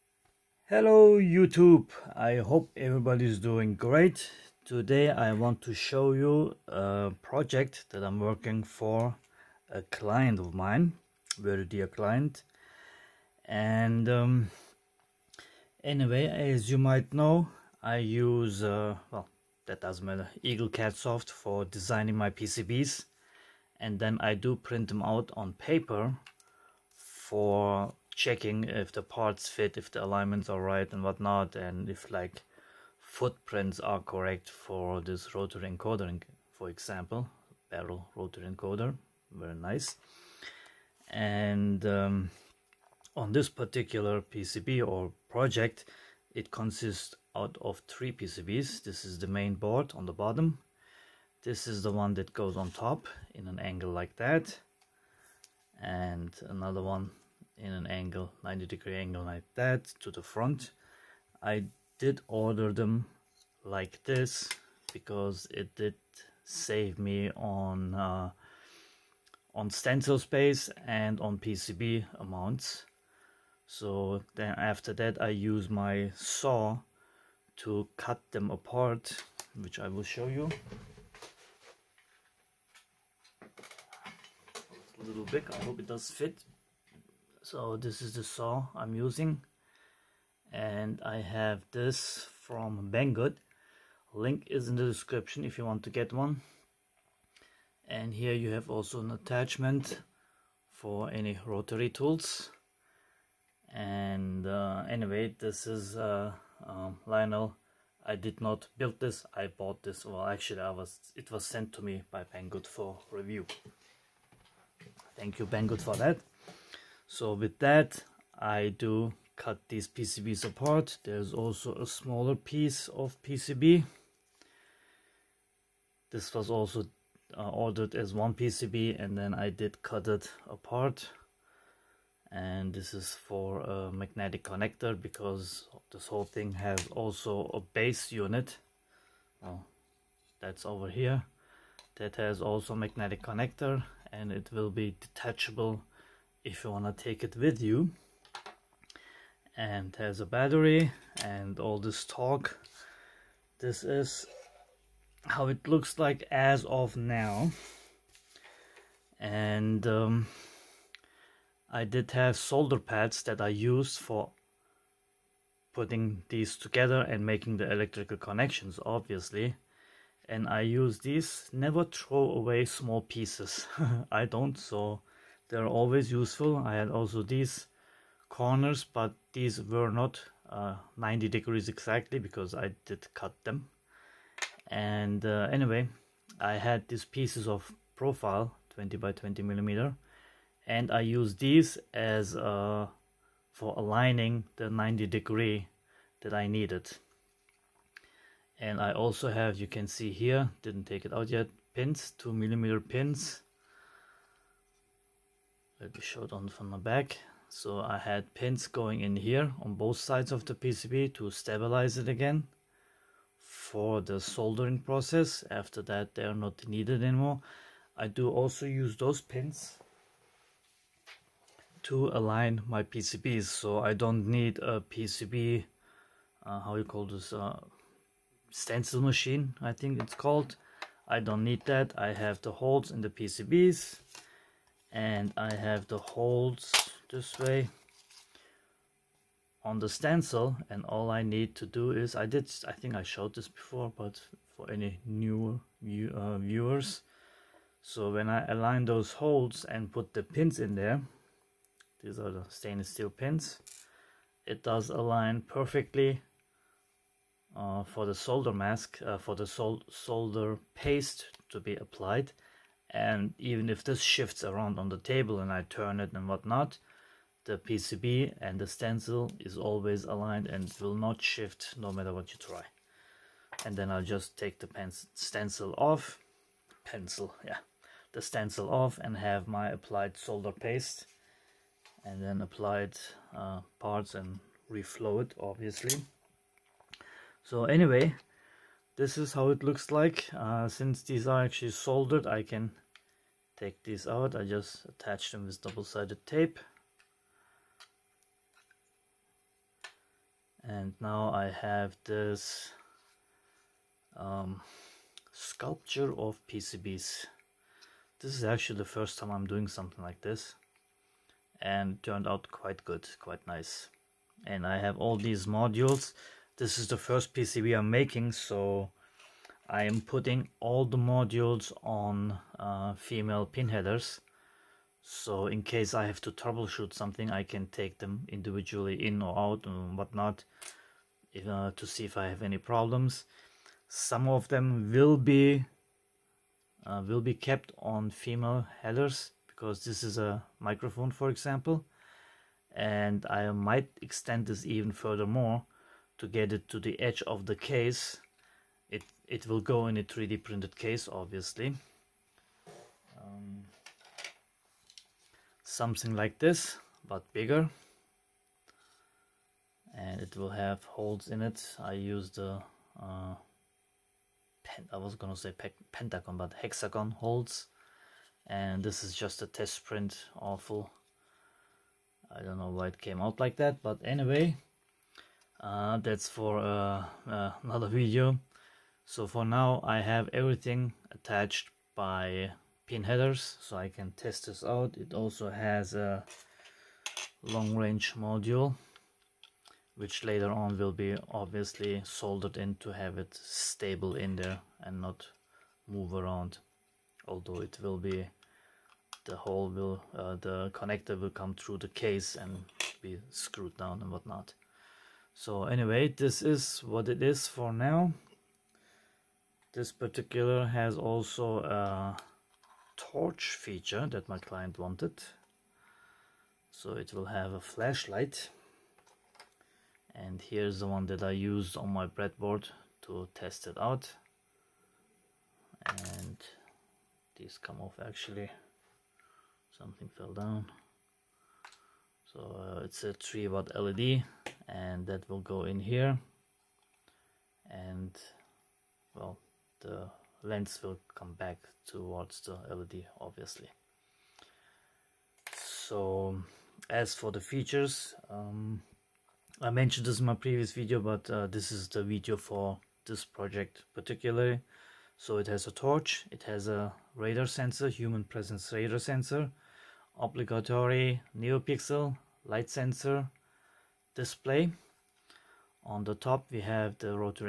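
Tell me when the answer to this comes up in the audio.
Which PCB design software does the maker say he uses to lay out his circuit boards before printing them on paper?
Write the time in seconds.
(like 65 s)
20 s.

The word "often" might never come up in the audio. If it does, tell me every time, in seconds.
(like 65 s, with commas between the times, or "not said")
not said.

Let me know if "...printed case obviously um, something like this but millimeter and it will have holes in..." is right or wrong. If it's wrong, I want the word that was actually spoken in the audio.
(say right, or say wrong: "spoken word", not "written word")
wrong: "bigger", not "millimeter".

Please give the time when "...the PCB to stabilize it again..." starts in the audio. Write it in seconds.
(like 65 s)
210 s.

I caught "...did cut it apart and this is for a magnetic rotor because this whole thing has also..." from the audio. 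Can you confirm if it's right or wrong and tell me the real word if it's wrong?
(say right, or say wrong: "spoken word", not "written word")
wrong: "connector", not "rotor".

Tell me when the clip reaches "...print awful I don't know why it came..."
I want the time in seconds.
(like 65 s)
369 s.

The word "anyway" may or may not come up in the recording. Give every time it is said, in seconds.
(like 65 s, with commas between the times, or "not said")
15 s, 104 s, 185 s, 287 s, 374 s, 405 s.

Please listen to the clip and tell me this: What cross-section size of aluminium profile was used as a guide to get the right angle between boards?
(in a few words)
20 by 20 millimeter.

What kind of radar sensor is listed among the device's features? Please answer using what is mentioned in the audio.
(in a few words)
Human presence radar sensor.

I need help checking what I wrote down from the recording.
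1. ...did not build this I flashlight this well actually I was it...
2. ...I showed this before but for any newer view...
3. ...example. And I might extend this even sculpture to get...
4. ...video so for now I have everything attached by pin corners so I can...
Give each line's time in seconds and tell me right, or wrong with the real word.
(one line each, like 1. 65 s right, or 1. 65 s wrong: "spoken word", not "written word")
1. 108 s wrong: "bought", not "flashlight"
2. 242 s right
3. 341 s wrong: "furthermore", not "sculpture"
4. 377 s wrong: "headers", not "corners".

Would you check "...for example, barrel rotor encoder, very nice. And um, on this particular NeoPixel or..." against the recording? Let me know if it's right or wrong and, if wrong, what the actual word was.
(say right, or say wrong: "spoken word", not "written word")
wrong: "PCB", not "NeoPixel".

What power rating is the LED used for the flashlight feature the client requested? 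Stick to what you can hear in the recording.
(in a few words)
3 watt.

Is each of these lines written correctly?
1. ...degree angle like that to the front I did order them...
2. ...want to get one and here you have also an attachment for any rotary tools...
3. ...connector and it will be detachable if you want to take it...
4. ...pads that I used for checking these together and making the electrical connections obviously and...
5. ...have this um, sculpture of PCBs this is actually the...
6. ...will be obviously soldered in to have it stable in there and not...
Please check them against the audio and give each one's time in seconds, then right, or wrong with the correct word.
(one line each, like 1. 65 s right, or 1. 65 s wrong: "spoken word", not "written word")
1. 58 s right
2. 95 s right
3. 143 s right
4. 162 s wrong: "putting", not "checking"
5. 301 s right
6. 390 s right.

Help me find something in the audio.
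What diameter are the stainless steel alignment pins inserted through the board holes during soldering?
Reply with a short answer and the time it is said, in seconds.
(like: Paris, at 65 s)
2 millimeter, at 202 s.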